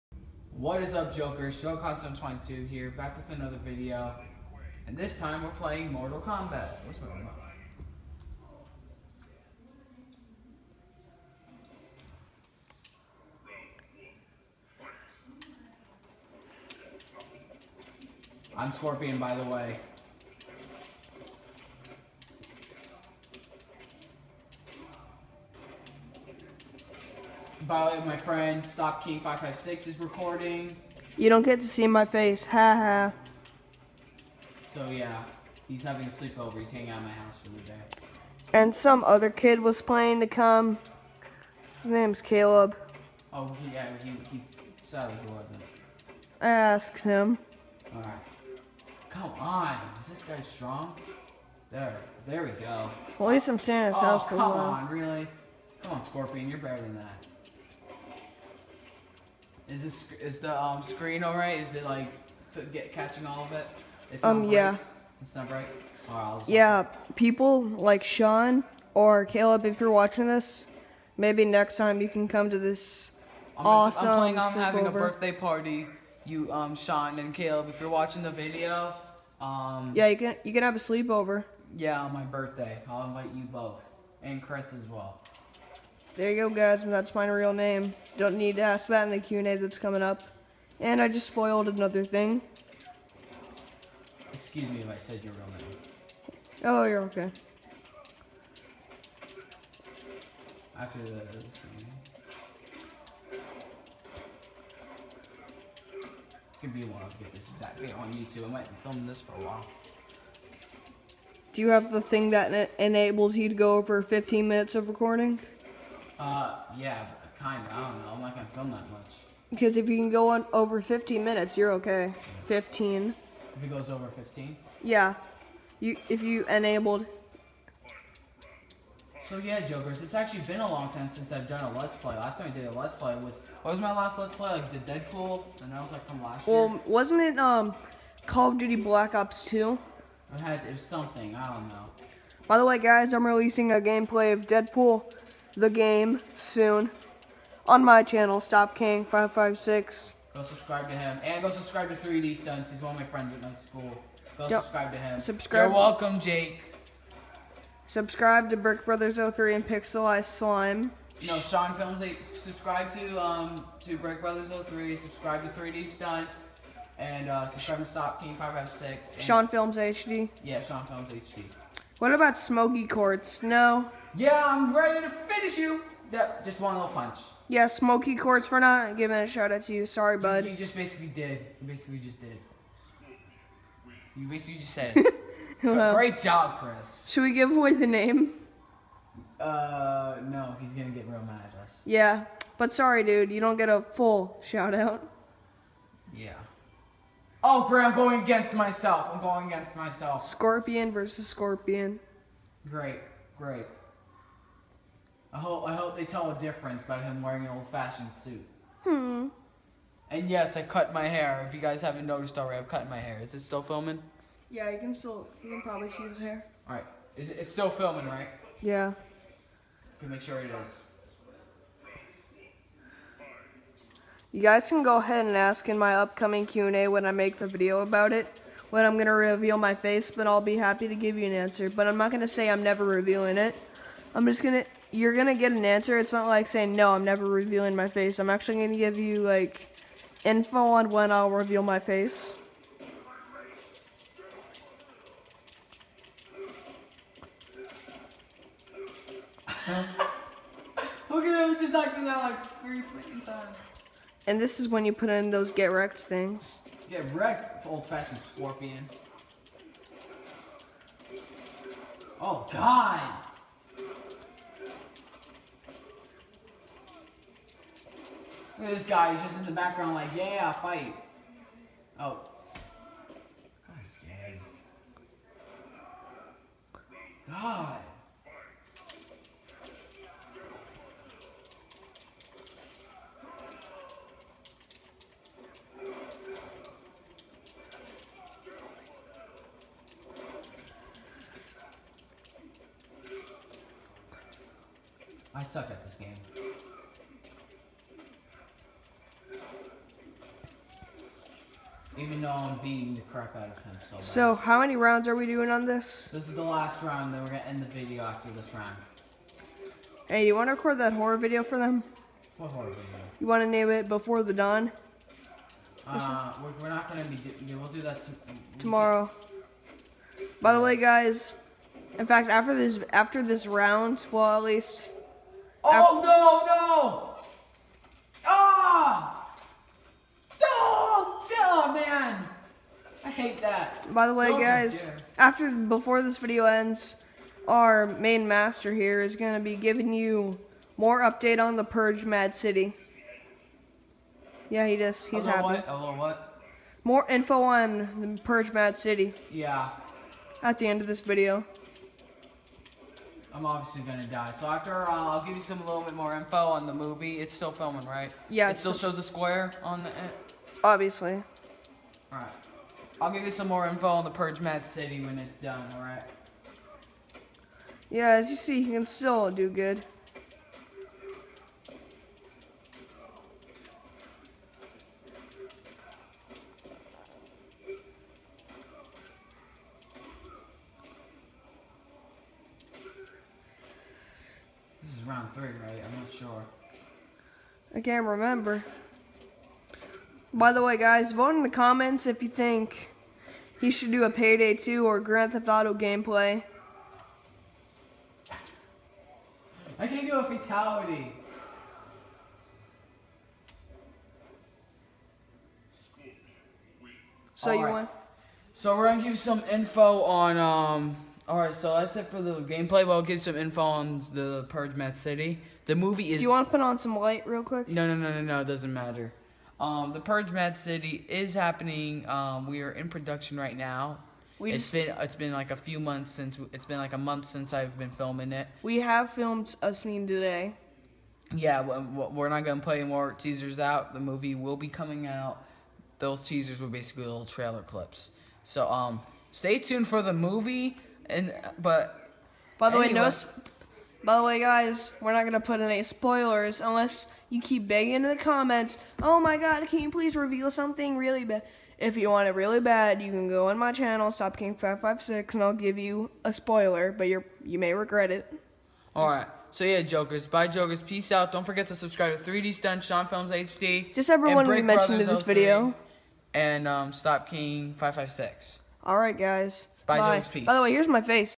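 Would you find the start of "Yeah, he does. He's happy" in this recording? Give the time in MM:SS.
05:44.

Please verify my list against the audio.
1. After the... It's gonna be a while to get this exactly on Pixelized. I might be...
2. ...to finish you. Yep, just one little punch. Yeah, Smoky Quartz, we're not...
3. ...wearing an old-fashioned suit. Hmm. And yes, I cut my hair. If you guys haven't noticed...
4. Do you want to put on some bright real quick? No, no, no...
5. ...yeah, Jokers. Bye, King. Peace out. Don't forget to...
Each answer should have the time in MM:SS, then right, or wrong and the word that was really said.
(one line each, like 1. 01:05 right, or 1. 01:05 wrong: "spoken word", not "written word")
1. 01:40 wrong: "YouTube", not "Pixelized"
2. 02:55 right
3. 03:27 right
4. 06:56 wrong: "light", not "bright"
5. 07:39 wrong: "Jokers", not "King".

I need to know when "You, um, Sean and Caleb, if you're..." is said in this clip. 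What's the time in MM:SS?
01:16.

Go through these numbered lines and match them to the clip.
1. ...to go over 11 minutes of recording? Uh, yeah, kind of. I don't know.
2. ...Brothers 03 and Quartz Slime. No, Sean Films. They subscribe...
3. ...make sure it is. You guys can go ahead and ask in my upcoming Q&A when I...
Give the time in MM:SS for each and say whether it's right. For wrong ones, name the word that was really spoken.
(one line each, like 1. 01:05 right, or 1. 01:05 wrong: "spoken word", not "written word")
1. 01:53 wrong: "15", not "11"
2. 02:38 wrong: "Pixelized", not "Quartz"
3. 03:40 right.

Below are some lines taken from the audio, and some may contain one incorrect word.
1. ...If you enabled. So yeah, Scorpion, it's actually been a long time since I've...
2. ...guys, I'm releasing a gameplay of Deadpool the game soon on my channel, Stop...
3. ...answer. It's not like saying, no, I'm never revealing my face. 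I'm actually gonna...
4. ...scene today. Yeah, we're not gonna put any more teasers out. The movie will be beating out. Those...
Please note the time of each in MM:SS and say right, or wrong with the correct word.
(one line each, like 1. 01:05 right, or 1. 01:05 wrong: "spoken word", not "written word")
1. 02:06 wrong: "Jokers", not "Scorpion"
2. 02:22 right
3. 03:55 right
4. 07:09 wrong: "coming", not "beating".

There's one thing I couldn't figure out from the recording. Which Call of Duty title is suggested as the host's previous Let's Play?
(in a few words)
Black Ops 2.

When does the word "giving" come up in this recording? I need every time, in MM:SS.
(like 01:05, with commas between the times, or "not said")
02:58, 05:39.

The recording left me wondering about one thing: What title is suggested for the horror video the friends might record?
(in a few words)
Before the Dawn.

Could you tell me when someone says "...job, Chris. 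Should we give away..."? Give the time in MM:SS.
03:06.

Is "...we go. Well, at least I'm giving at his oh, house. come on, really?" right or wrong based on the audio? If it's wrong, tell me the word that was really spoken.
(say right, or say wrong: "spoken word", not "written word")
wrong: "standing", not "giving".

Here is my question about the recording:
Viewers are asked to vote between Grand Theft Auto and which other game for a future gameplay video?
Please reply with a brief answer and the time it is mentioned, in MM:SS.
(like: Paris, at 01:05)
Payday 2, at 06:34.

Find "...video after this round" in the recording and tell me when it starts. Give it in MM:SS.
05:07.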